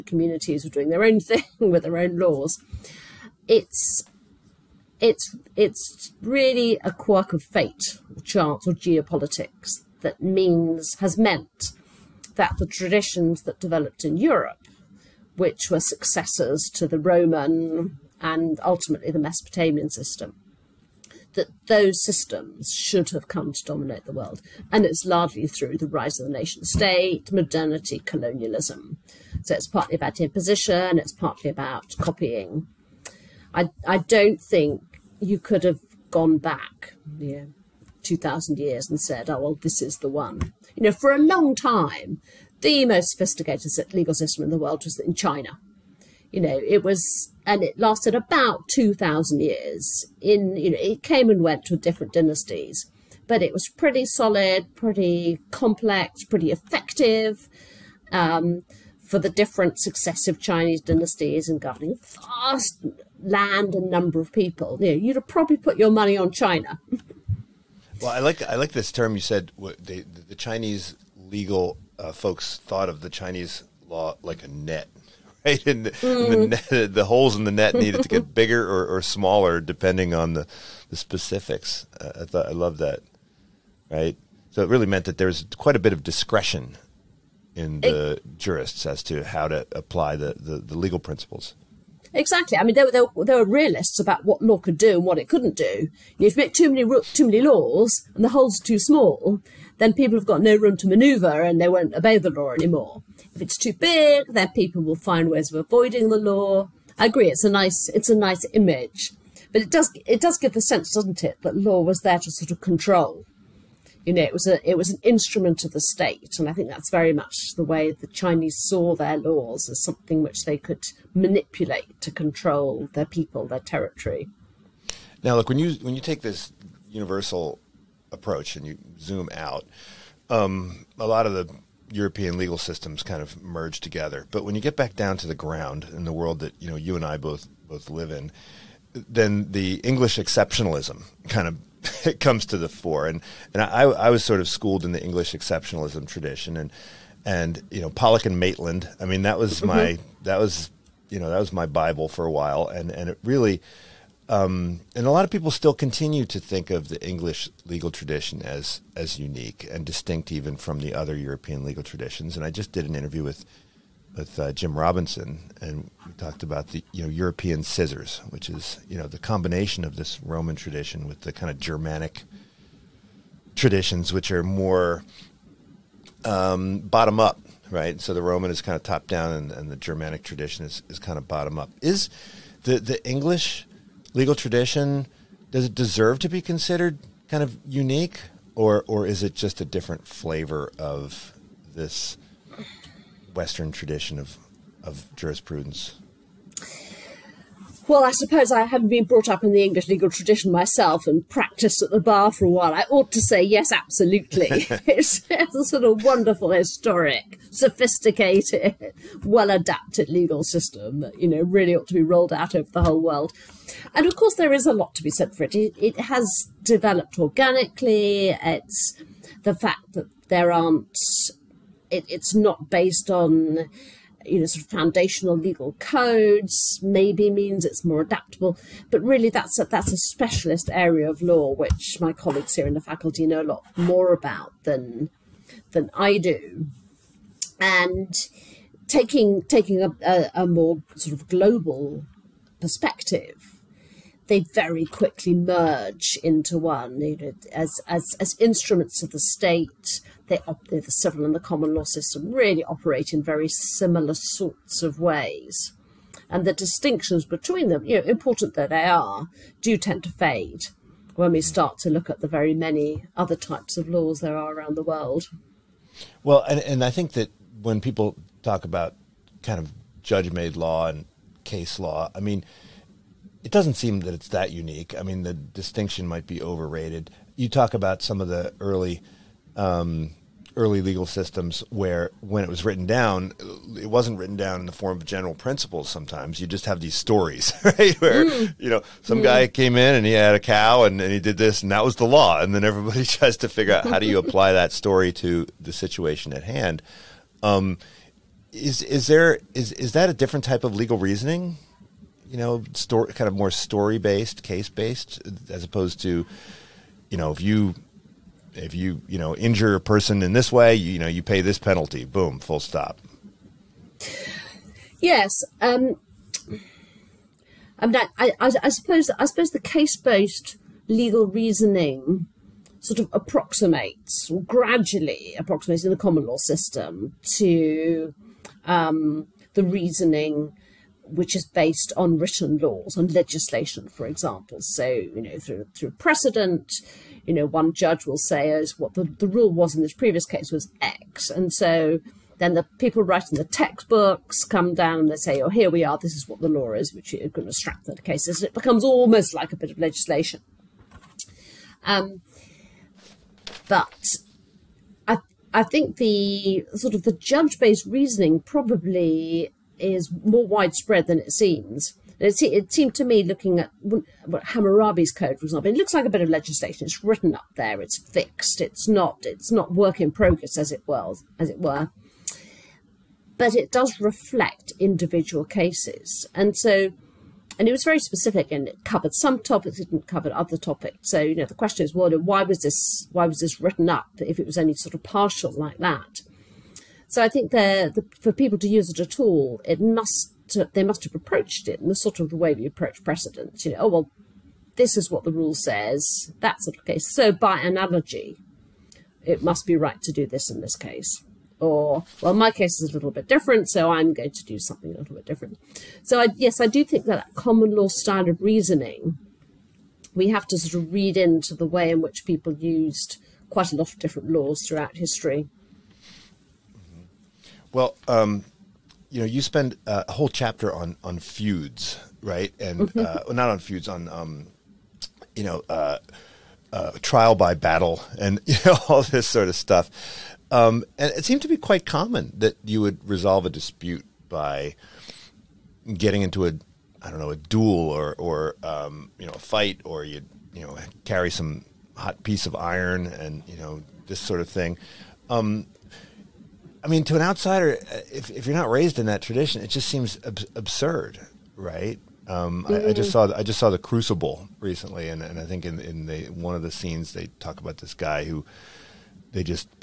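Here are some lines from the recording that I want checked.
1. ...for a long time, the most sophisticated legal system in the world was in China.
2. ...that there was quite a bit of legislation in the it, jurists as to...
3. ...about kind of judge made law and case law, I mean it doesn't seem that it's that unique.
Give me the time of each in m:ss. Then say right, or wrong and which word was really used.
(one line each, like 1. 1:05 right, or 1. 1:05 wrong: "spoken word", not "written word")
1. 0:40 right
2. 1:25 wrong: "discretion", not "legislation"
3. 4:28 right.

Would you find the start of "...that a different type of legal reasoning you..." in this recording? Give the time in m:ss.
4:59.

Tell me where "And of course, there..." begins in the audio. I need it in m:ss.
3:33.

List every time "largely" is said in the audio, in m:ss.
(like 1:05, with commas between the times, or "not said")
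0:25.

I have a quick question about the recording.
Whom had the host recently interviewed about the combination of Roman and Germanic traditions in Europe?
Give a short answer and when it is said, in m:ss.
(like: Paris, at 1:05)
Jim Robinson, at 2:44.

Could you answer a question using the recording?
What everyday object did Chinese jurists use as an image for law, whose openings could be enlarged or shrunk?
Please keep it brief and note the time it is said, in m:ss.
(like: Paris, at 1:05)
A net, at 1:14.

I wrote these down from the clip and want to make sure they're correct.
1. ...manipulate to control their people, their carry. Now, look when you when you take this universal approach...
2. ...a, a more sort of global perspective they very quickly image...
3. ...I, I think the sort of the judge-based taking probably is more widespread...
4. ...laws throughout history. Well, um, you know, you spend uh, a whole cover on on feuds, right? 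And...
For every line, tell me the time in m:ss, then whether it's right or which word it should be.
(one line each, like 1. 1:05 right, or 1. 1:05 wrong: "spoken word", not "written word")
1. 2:01 wrong: "territory", not "carry"
2. 4:00 wrong: "merge", not "image"
3. 5:55 wrong: "reasoning", not "taking"
4. 6:54 wrong: "chapter", not "cover".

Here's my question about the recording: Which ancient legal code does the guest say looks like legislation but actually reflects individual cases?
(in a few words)
Hammurabi's code.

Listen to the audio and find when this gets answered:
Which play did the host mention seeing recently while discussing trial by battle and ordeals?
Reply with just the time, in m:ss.
7:33.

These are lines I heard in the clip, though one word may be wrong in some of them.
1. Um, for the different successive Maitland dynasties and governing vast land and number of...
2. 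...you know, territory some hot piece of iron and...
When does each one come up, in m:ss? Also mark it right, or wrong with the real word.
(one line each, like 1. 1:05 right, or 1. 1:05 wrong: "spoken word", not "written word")
1. 0:58 wrong: "Chinese", not "Maitland"
2. 7:20 wrong: "carry", not "territory".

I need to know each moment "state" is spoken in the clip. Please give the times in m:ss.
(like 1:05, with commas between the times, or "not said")
0:26, 1:55, 4:09.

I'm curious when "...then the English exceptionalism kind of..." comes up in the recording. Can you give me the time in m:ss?
2:18.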